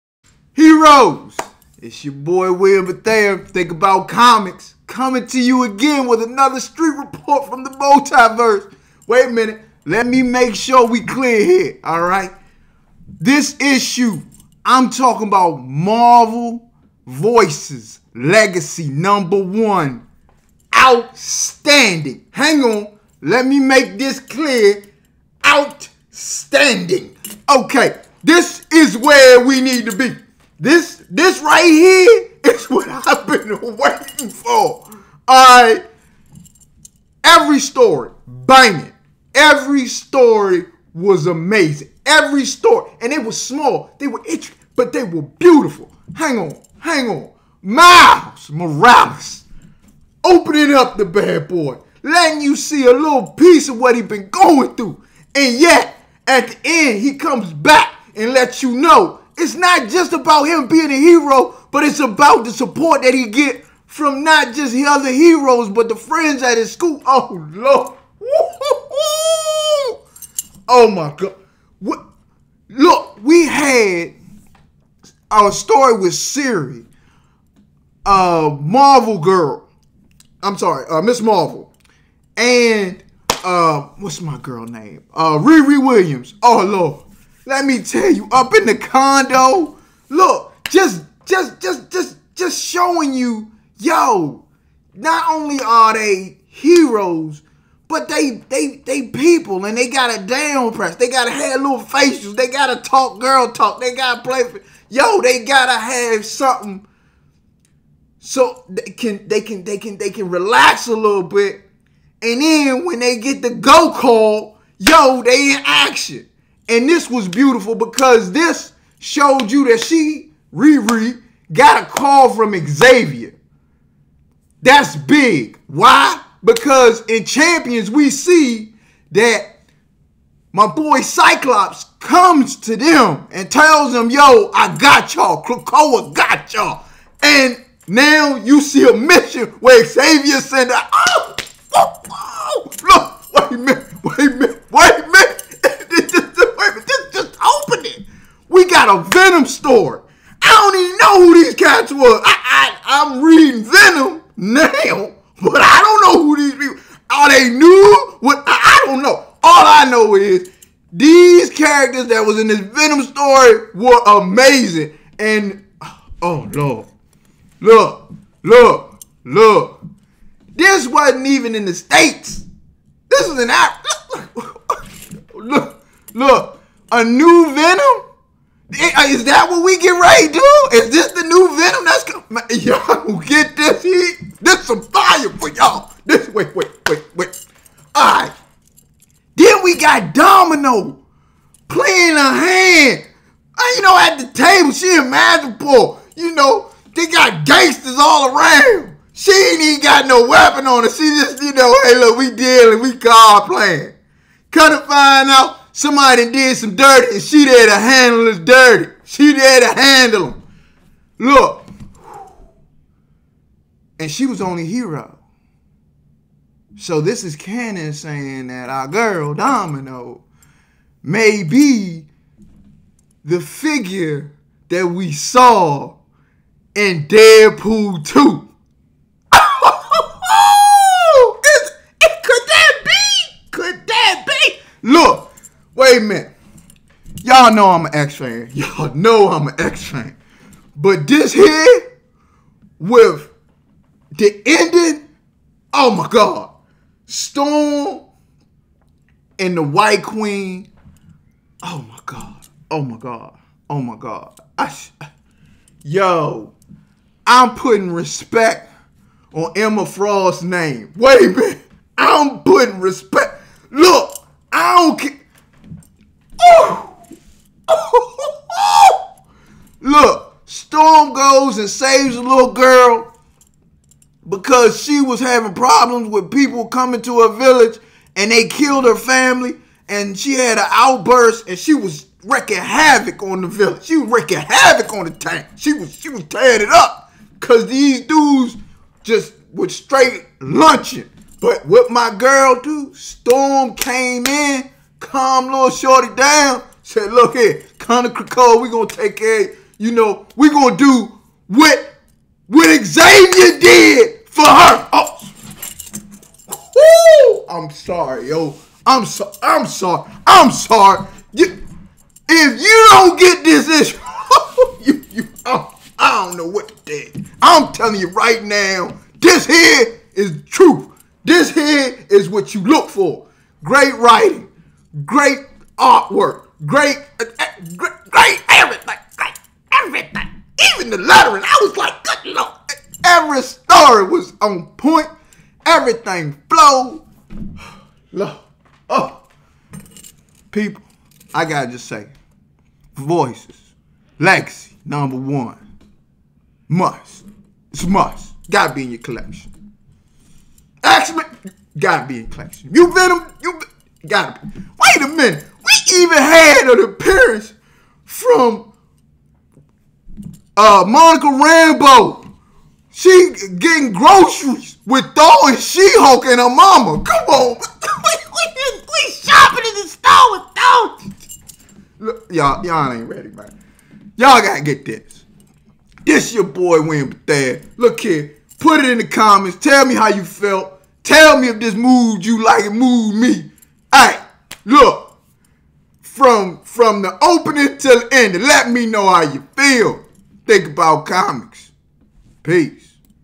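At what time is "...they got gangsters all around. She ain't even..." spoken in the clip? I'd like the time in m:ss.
3:16.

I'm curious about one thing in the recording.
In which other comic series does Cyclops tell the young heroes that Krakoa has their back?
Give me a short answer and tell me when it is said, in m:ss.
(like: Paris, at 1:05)
Champions, at 2:07.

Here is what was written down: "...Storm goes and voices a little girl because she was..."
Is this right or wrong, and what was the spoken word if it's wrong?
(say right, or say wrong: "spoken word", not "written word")
wrong: "saves", not "voices".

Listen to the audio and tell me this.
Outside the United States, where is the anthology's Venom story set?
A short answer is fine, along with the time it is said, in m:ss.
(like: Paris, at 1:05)
Africa, at 2:53.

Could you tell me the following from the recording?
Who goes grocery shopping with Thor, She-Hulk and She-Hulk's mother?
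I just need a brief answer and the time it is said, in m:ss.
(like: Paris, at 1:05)
Monica Rambeau, at 6:00.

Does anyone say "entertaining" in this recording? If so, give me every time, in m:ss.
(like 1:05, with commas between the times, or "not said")
not said.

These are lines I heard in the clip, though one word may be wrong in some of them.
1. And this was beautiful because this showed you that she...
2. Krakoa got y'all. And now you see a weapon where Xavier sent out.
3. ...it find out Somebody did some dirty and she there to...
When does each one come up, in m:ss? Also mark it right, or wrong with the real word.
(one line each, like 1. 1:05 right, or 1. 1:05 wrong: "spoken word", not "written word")
1. 1:56 right
2. 2:15 wrong: "mission", not "weapon"
3. 3:24 right.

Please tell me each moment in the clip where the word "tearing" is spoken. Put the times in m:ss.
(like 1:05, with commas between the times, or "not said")
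4:46.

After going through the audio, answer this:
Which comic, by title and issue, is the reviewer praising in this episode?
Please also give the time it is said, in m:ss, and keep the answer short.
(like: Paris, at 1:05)
Marvel Voices Legacy #1, at 0:15.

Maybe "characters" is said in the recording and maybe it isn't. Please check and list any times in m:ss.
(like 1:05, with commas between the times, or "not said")
2:41.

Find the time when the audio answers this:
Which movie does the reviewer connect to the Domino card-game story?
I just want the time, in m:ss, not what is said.
3:47.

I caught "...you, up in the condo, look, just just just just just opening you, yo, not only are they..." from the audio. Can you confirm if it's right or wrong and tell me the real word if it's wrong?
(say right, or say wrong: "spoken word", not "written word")
wrong: "showing", not "opening".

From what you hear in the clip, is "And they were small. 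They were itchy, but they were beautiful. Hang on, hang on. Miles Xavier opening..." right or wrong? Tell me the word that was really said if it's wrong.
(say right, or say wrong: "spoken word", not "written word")
wrong: "Morales", not "Xavier".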